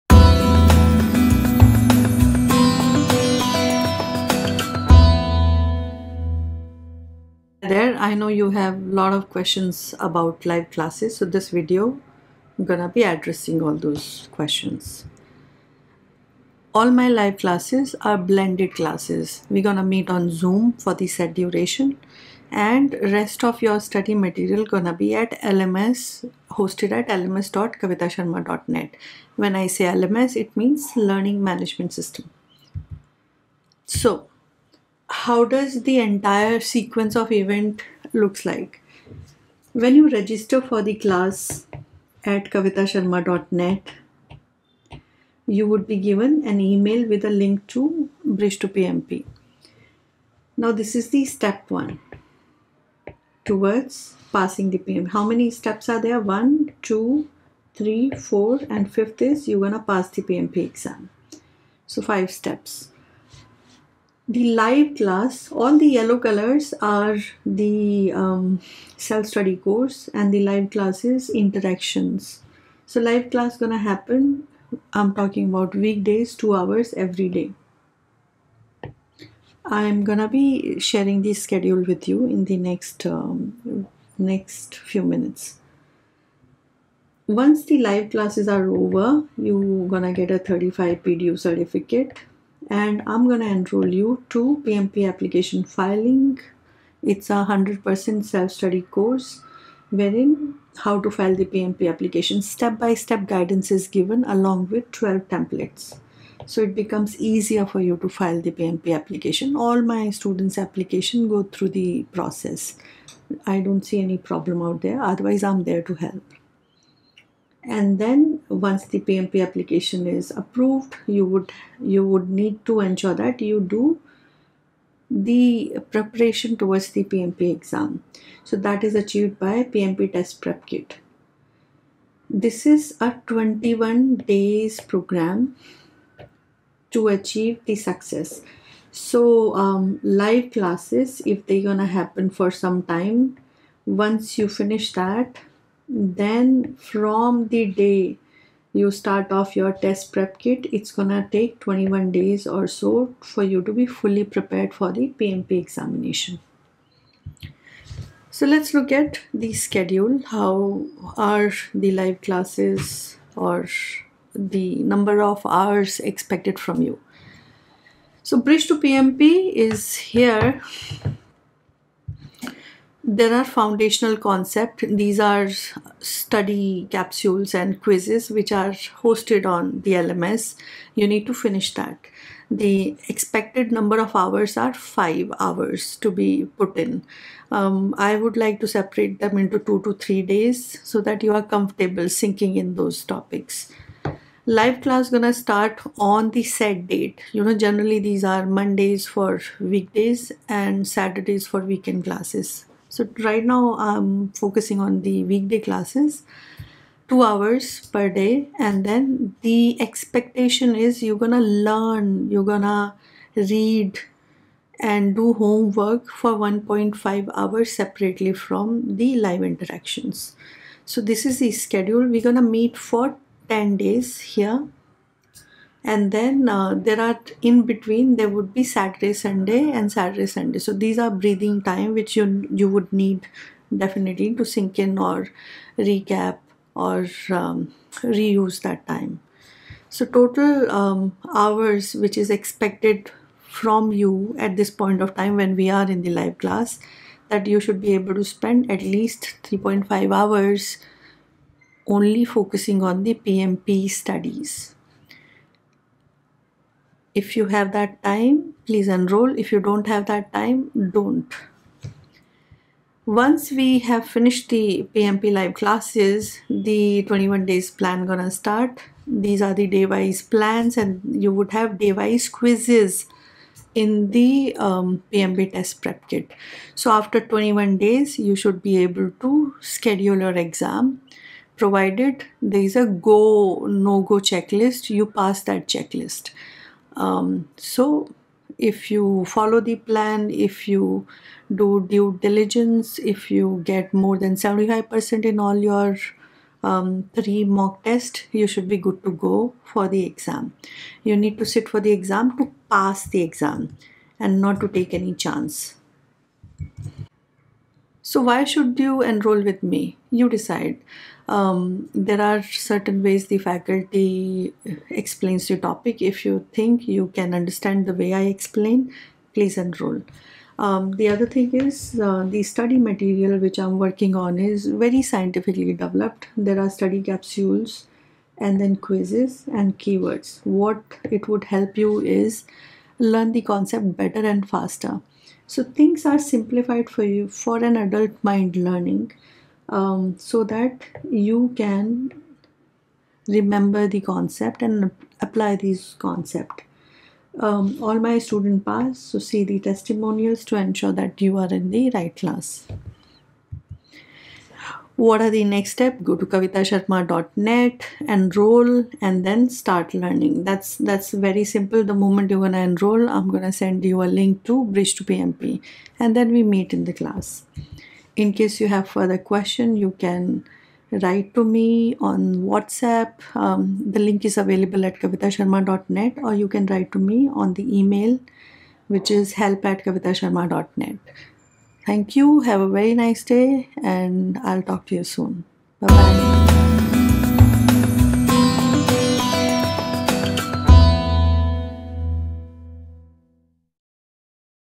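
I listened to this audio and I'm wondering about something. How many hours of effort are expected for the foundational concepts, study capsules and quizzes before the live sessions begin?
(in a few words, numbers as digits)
5 hours.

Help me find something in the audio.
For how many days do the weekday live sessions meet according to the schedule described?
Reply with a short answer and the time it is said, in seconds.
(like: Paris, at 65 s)
10, at 223 s.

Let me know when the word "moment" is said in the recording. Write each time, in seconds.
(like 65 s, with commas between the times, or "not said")
362 s.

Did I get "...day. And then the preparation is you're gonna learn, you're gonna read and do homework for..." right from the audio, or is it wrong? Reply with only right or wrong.
wrong.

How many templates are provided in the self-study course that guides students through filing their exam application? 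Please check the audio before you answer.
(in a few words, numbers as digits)
12.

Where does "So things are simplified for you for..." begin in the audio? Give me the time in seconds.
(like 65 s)
335 s.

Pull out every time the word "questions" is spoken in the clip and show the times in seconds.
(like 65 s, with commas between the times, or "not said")
9 s, 14 s, 369 s.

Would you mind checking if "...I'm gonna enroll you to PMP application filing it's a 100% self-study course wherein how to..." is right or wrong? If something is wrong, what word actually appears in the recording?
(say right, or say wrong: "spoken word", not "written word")
right.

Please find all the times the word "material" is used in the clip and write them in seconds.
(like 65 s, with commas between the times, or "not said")
24 s, 322 s.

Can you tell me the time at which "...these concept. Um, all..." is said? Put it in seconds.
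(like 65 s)
345 s.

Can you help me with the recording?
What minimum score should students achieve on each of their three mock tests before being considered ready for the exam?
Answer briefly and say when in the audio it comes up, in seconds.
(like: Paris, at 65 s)
75%, at 294 s.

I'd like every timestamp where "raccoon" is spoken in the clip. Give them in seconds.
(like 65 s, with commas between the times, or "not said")
not said.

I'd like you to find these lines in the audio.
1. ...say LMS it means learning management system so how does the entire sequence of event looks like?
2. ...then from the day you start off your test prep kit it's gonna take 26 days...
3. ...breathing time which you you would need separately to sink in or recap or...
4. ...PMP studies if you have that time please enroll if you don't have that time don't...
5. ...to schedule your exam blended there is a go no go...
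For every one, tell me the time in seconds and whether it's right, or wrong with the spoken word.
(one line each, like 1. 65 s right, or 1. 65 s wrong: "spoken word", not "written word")
1. 29 s right
2. 145 s wrong: "21", not "26"
3. 231 s wrong: "definitely", not "separately"
4. 253 s right
5. 279 s wrong: "provided", not "blended".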